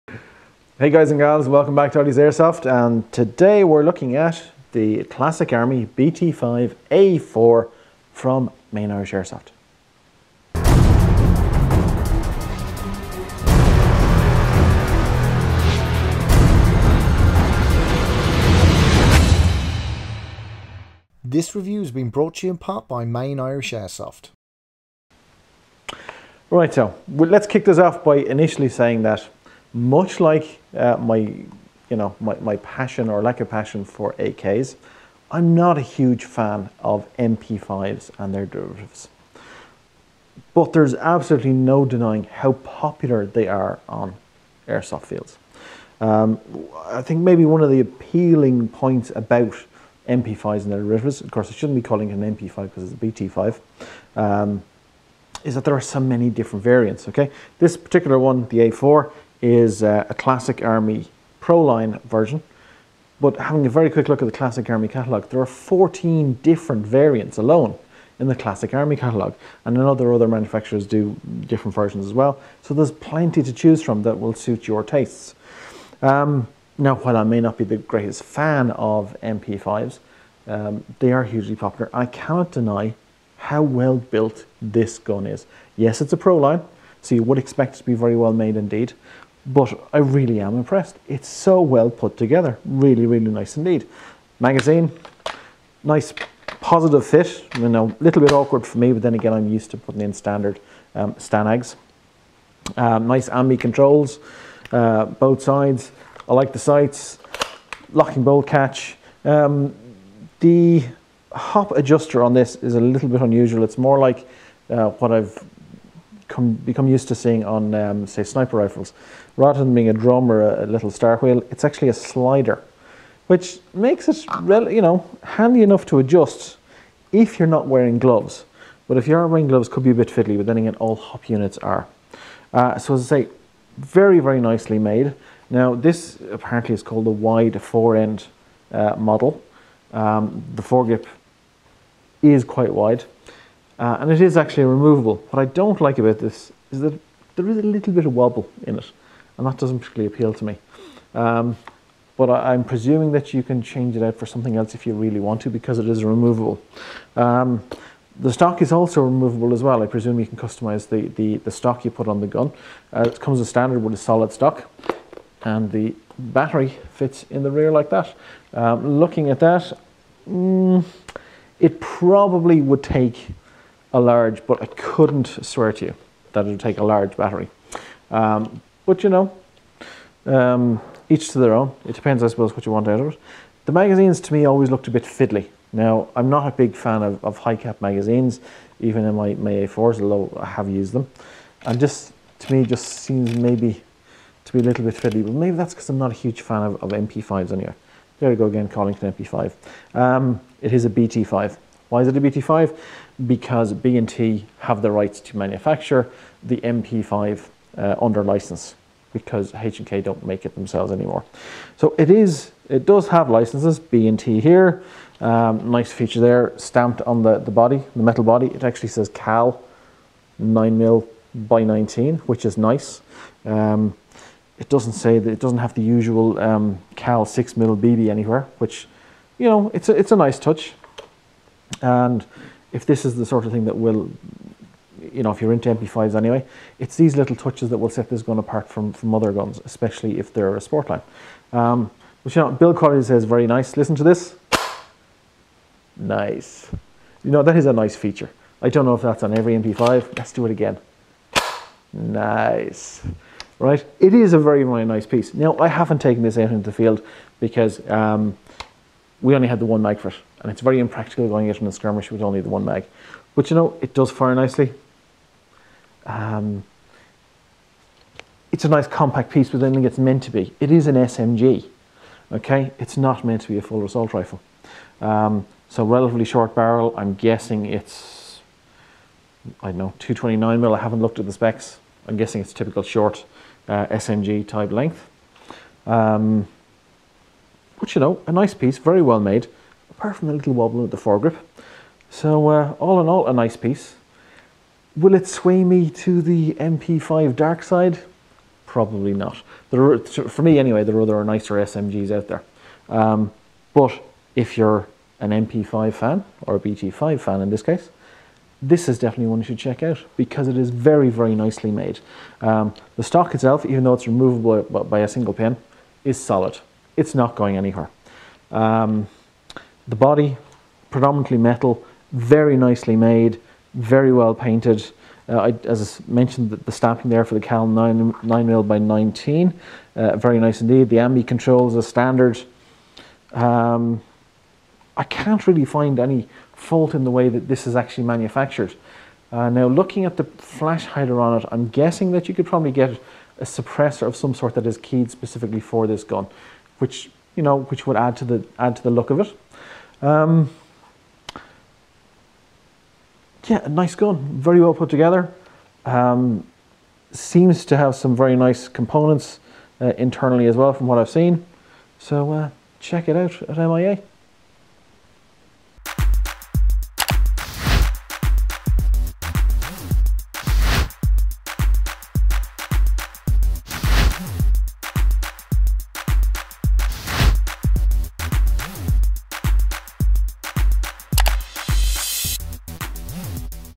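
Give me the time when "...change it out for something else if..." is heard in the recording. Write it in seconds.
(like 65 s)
153 s.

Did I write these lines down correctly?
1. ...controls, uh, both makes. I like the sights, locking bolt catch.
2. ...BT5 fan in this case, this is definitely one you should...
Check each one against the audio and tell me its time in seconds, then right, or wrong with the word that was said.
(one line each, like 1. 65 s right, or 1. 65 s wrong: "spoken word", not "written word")
1. 103 s wrong: "sides", not "makes"
2. 306 s right.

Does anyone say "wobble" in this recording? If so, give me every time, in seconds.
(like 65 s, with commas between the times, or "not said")
148 s, 290 s.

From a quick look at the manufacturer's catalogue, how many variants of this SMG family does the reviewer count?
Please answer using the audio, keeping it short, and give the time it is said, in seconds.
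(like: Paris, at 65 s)
14, at 65 s.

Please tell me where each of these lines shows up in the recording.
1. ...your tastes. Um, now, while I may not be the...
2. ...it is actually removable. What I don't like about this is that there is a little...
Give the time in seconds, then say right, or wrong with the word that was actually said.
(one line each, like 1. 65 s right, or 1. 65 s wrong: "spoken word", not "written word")
1. 74 s right
2. 144 s right.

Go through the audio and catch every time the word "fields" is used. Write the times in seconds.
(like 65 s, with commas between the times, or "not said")
45 s, 256 s.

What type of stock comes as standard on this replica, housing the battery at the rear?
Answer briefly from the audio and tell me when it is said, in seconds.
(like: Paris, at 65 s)
Solid stock, at 163 s.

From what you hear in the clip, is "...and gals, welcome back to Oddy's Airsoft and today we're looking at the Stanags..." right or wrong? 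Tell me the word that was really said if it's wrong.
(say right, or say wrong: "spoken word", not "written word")
wrong: "Classic", not "Stanags".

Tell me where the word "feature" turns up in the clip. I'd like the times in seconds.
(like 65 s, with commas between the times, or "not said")
215 s, 247 s.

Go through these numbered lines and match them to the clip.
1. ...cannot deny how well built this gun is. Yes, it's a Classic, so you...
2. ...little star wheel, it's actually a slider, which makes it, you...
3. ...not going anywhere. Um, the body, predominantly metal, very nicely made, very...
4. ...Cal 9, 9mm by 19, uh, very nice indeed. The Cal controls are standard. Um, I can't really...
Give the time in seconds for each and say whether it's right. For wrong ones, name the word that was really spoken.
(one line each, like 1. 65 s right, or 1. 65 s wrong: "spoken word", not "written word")
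1. 82 s wrong: "Proline", not "Classic"
2. 120 s right
3. 317 s right
4. 327 s wrong: "Ambi", not "Cal".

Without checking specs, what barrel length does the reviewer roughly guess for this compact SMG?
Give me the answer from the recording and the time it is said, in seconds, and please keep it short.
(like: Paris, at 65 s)
229 mm, at 279 s.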